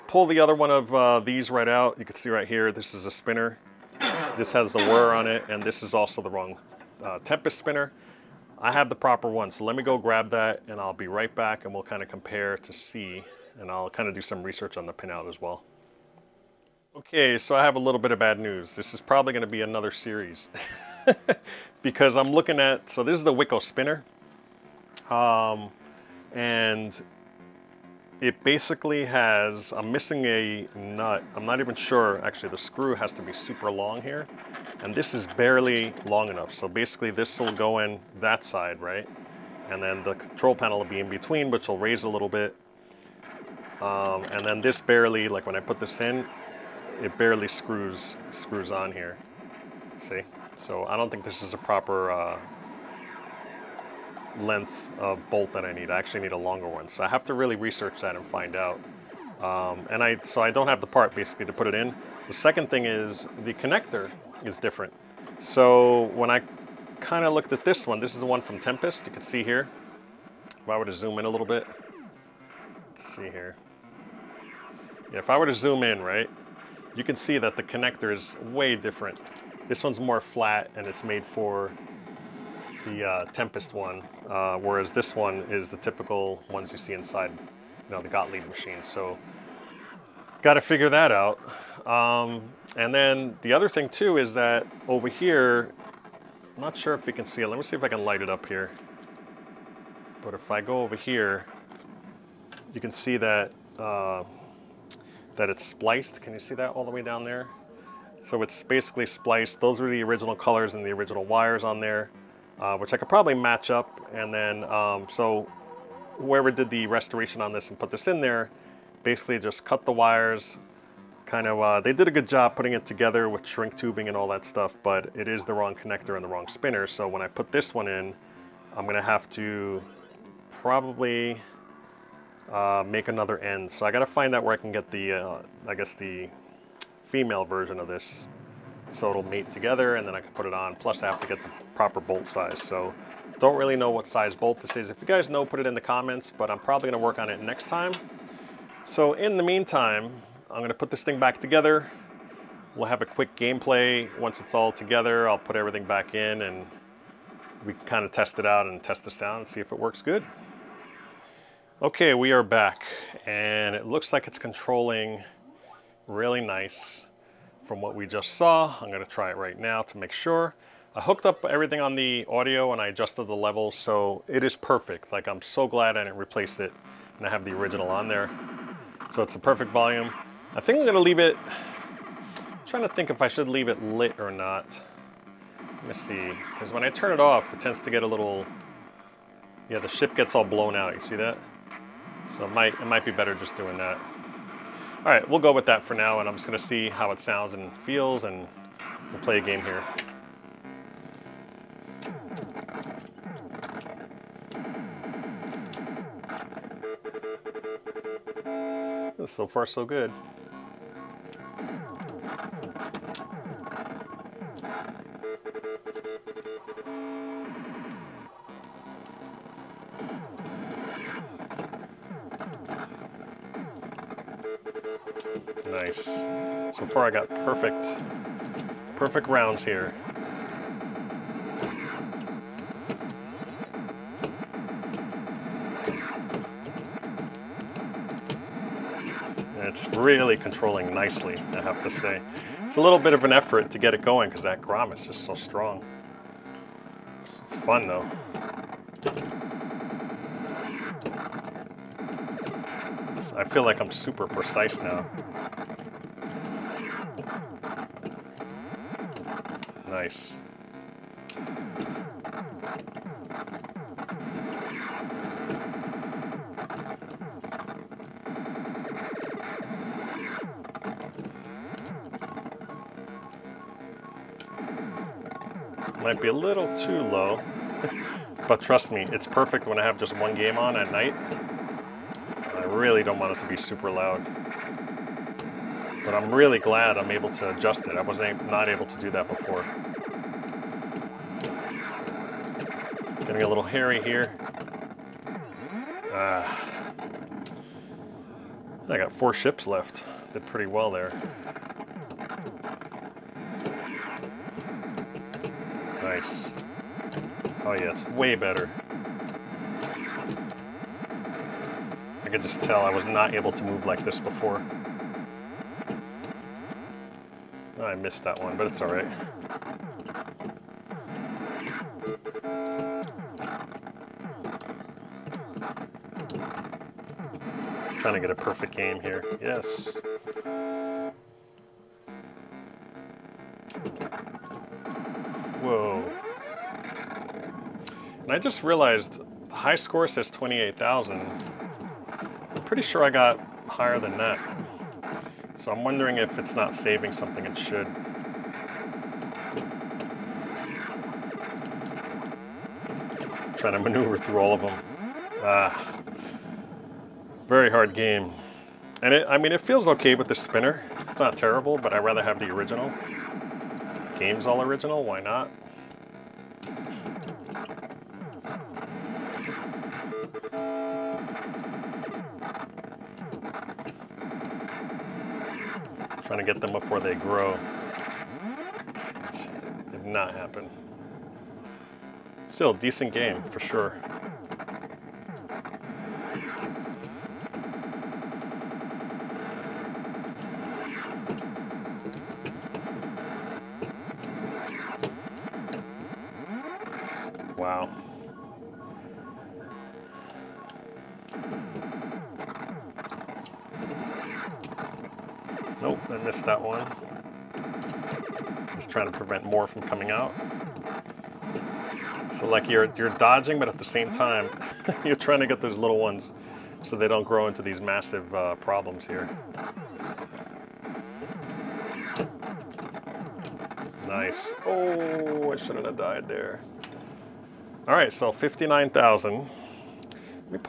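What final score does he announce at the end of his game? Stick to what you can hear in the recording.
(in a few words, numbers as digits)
59,000.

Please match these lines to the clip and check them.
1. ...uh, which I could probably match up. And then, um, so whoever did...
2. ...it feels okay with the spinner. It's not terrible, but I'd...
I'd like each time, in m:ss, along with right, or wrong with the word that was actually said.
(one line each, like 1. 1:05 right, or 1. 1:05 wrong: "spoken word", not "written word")
1. 1:52 right
2. 5:59 right.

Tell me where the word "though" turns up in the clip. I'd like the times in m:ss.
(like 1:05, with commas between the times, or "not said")
4:07.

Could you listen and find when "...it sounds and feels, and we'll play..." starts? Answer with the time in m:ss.
3:17.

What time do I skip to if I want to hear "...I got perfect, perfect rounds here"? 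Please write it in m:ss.
3:47.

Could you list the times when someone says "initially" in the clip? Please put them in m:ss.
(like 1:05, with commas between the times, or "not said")
not said.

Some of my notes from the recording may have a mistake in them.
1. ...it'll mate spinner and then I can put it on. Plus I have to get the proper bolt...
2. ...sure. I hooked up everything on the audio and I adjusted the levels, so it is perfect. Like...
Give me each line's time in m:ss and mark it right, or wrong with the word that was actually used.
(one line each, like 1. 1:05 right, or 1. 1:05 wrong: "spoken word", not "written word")
1. 2:19 wrong: "together", not "spinner"
2. 2:50 right.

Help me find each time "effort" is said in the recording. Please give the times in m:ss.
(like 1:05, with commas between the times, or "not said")
4:03.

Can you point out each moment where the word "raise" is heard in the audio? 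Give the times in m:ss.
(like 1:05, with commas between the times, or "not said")
0:41.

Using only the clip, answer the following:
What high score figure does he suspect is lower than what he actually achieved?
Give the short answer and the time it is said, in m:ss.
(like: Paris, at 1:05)
28,000, at 5:40.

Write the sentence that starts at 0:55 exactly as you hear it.
I actually need a longer one.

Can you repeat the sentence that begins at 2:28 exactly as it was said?
So in the meantime, I'm gonna put this thing back together.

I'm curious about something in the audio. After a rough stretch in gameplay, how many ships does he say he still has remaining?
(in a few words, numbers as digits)
4.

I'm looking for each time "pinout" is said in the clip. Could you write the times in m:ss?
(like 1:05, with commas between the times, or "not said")
0:14.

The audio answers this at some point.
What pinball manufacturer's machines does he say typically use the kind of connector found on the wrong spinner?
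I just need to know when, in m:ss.
1:28.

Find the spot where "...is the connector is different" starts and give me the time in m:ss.
1:02.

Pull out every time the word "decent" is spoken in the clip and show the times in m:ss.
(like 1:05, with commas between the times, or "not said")
6:22.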